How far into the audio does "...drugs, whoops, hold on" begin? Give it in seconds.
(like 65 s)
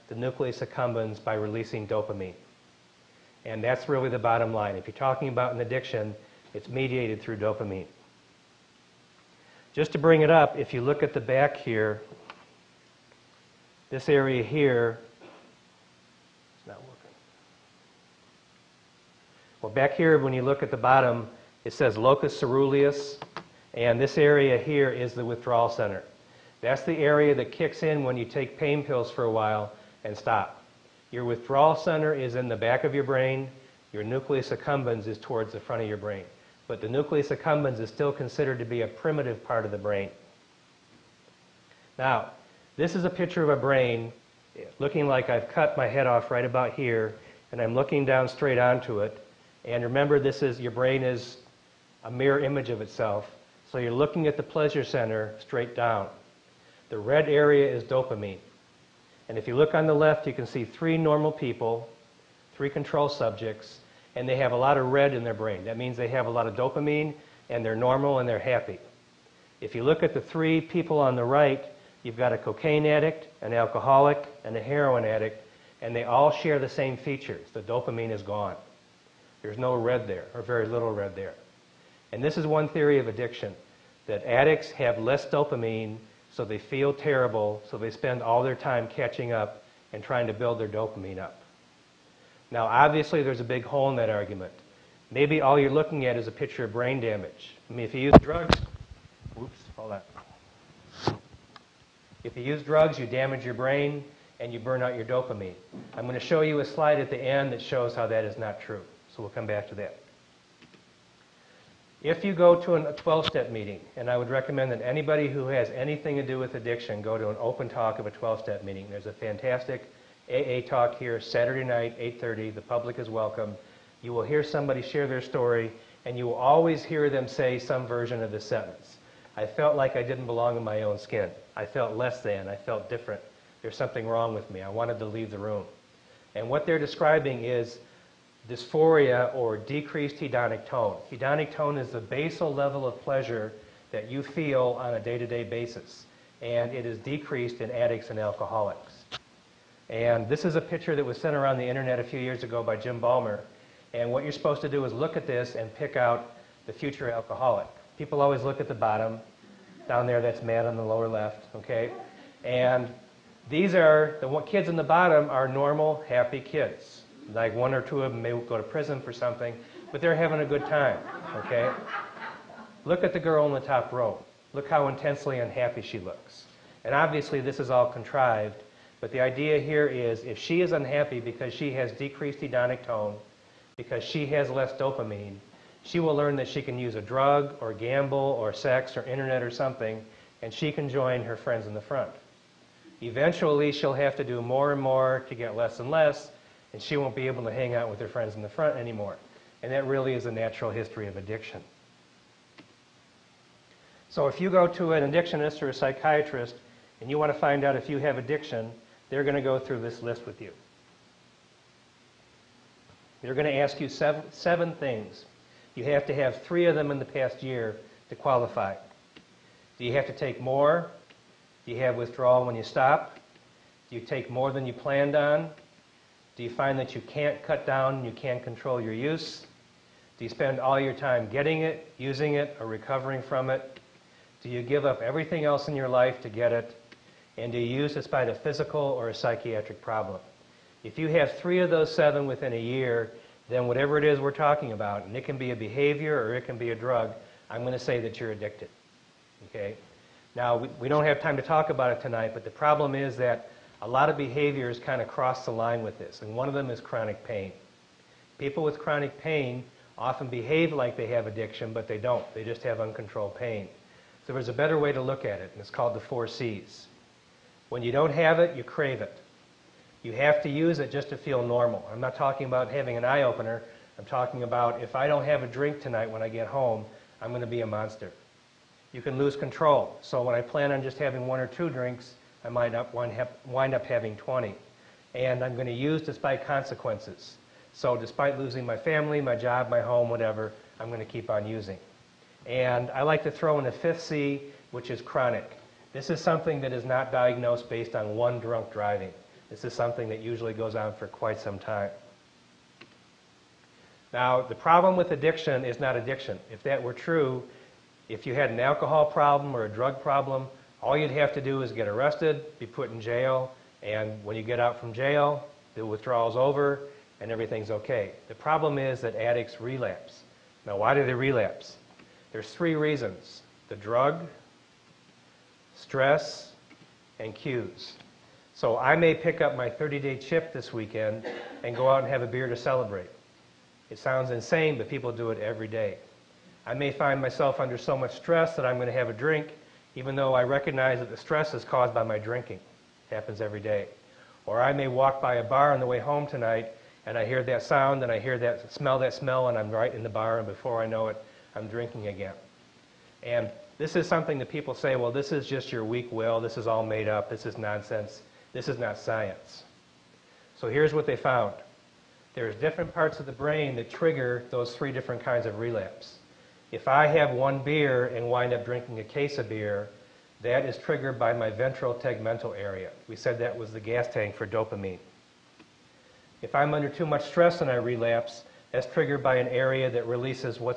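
98 s.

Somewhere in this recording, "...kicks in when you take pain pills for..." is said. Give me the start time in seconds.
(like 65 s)
27 s.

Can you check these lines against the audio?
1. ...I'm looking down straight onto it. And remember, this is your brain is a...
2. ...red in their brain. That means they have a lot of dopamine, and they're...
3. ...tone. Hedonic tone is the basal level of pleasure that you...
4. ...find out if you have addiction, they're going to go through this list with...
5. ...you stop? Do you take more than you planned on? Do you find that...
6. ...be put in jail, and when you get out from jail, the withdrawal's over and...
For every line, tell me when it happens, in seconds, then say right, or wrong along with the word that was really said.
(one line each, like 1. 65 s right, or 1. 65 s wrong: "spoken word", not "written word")
1. 47 s right
2. 64 s right
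3. 140 s right
4. 207 s right
5. 222 s right
6. 312 s right.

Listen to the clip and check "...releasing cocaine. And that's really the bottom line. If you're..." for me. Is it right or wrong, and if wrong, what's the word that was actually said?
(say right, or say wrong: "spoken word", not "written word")
wrong: "dopamine", not "cocaine".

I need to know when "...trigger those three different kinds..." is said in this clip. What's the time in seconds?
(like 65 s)
363 s.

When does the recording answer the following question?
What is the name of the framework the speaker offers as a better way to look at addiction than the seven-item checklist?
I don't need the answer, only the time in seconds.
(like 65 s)
265 s.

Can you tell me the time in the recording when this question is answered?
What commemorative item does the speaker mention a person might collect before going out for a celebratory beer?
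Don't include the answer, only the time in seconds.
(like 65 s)
329 s.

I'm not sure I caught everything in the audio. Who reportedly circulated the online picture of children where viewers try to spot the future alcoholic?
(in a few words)
Jim Balmer.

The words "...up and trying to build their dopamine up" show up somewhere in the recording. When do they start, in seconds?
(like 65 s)
89 s.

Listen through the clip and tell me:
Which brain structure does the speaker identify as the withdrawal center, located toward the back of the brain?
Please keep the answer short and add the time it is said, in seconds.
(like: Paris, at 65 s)
Locus ceruleus, at 21 s.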